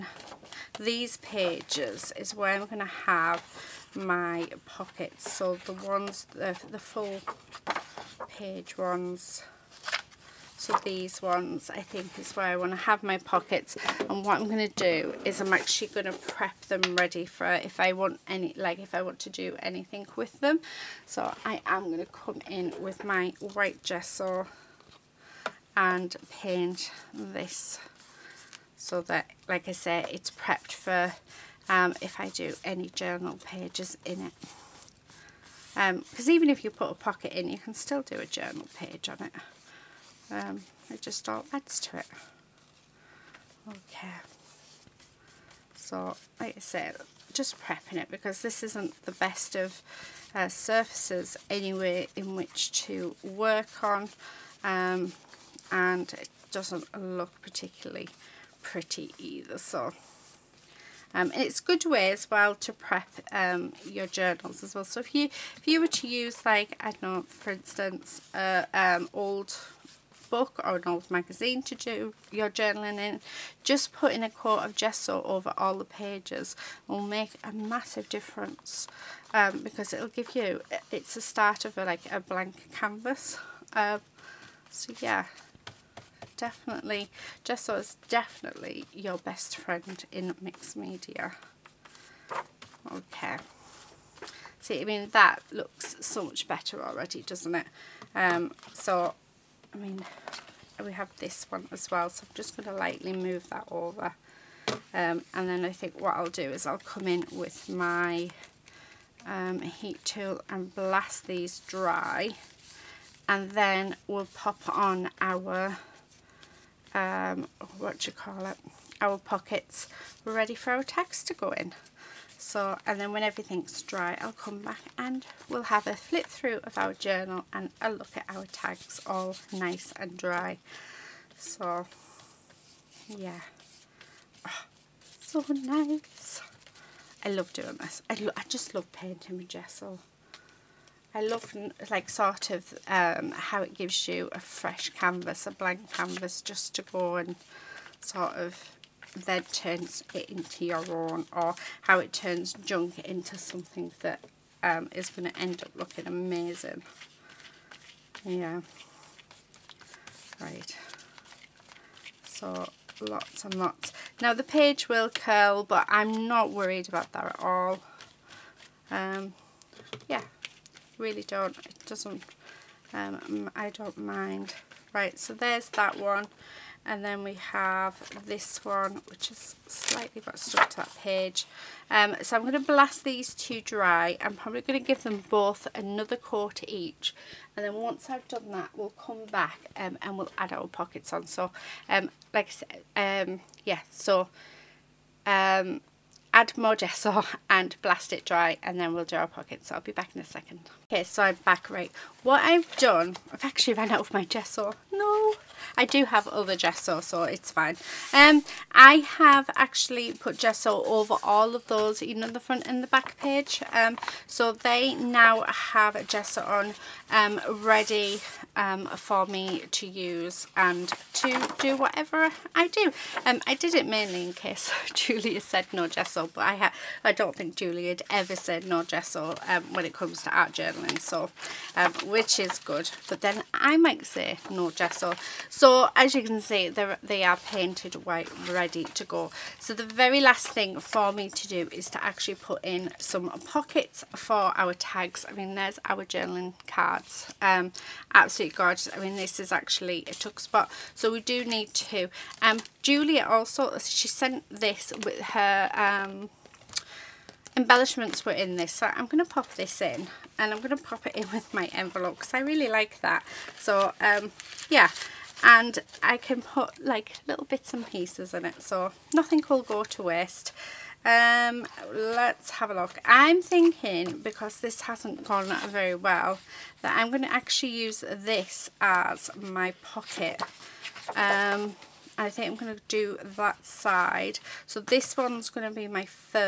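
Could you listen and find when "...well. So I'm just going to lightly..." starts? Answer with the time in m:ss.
1:41.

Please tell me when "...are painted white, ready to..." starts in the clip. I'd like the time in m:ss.
3:57.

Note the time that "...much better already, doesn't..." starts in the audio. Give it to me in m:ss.
1:36.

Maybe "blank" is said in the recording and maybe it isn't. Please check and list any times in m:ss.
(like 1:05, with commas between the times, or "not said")
1:22, 2:25.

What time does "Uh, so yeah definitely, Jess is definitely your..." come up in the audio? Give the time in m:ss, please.
1:23.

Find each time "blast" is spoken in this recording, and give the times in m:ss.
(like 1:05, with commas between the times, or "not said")
1:50, 3:02, 3:17.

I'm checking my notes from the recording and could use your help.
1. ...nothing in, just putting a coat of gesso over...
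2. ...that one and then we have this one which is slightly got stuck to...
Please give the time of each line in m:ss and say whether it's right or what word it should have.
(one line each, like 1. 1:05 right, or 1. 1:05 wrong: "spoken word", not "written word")
1. 1:12 wrong: "journaling", not "nothing"
2. 2:55 right.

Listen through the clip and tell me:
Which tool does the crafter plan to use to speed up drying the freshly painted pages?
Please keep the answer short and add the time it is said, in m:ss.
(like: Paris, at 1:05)
Heat tool, at 1:49.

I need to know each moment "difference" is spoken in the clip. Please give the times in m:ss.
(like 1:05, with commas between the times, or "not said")
1:18.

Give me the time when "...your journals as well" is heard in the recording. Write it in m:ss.
1:03.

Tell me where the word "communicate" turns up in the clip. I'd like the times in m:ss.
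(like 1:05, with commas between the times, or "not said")
not said.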